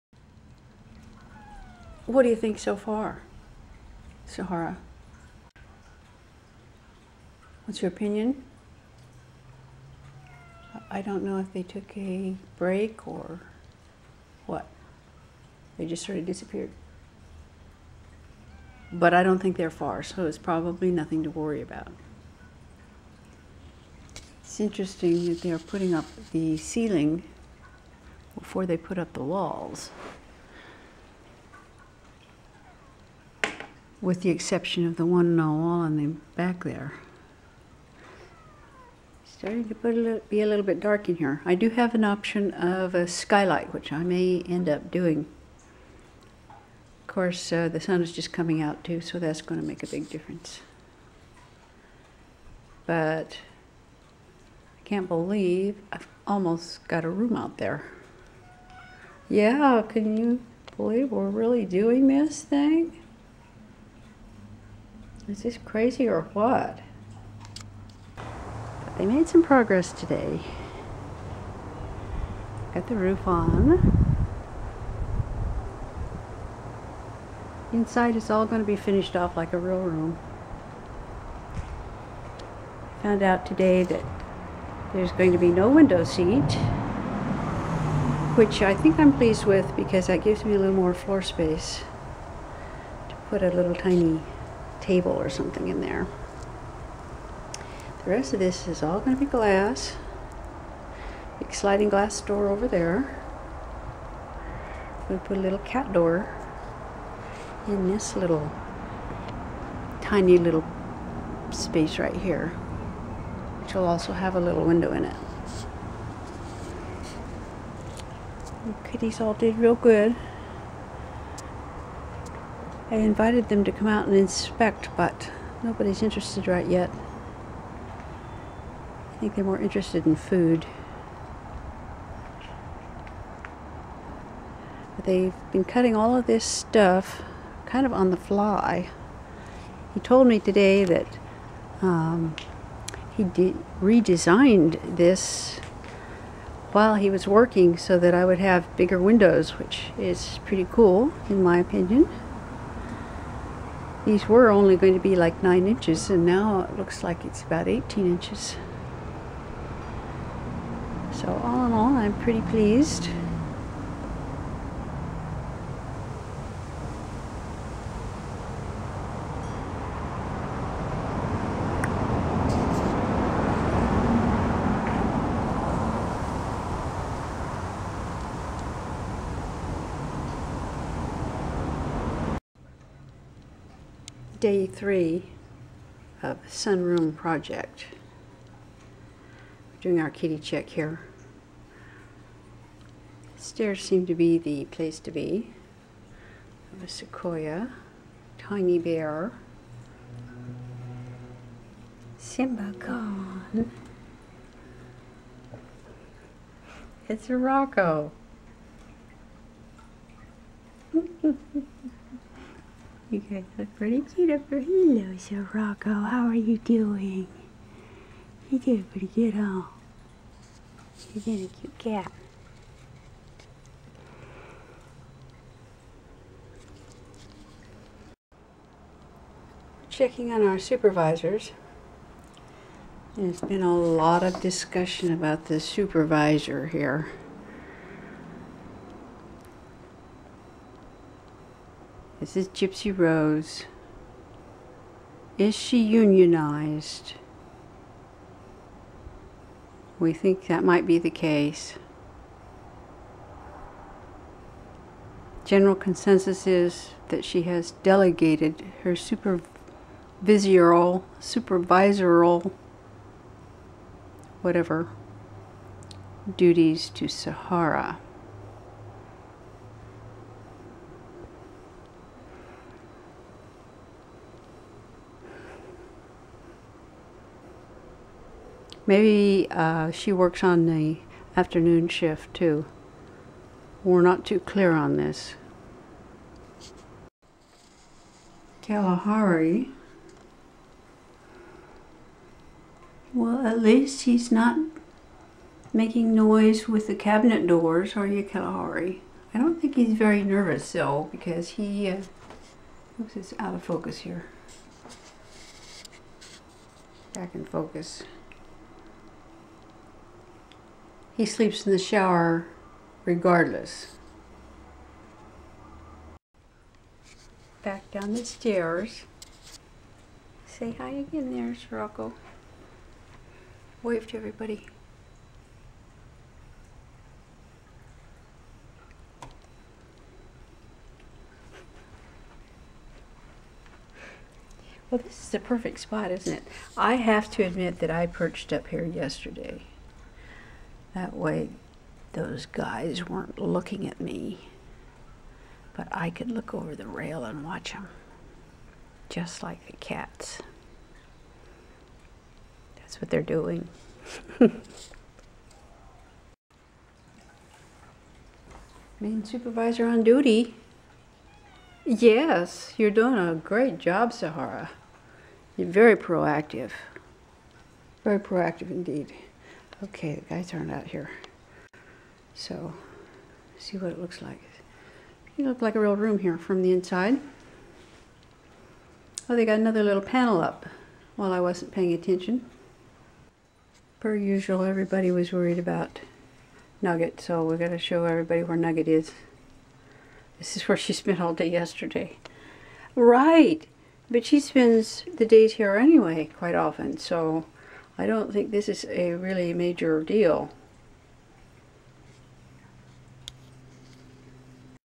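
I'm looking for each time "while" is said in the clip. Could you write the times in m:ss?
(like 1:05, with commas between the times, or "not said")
2:26, 6:21.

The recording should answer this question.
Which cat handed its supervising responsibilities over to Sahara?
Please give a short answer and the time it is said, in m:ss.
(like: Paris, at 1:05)
Gypsy Rose, at 4:02.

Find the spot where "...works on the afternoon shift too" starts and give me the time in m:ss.
4:40.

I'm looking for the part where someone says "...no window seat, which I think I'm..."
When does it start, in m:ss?
1:25.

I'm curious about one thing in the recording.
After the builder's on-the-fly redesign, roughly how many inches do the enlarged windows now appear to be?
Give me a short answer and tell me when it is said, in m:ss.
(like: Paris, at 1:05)
18 inches, at 2:37.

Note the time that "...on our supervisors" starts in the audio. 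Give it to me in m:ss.
3:50.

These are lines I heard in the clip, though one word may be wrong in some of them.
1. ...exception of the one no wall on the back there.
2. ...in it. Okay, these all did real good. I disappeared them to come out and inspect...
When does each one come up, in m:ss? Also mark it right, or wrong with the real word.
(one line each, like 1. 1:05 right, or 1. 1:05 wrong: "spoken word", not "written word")
1. 0:34 right
2. 1:54 wrong: "invited", not "disappeared".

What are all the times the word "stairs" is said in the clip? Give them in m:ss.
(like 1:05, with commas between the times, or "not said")
3:13, 5:18.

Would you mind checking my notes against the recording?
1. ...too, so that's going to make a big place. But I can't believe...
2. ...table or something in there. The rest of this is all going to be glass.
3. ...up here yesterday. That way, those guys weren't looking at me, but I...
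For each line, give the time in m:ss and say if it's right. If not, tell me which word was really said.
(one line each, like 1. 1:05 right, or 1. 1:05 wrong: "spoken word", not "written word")
1. 0:48 wrong: "difference", not "place"
2. 1:34 right
3. 5:38 right.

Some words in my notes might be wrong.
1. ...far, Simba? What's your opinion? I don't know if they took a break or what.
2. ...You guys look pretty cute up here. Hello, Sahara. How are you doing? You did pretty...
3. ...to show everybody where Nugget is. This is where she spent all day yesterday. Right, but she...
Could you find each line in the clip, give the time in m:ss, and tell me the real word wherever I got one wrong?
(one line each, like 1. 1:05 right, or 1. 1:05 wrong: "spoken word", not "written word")
1. 0:02 wrong: "Sahara", not "Simba"
2. 3:33 wrong: "Sirocco", not "Sahara"
3. 6:27 right.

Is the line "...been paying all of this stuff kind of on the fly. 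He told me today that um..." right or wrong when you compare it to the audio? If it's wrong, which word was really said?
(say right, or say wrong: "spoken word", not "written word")
wrong: "cutting", not "paying".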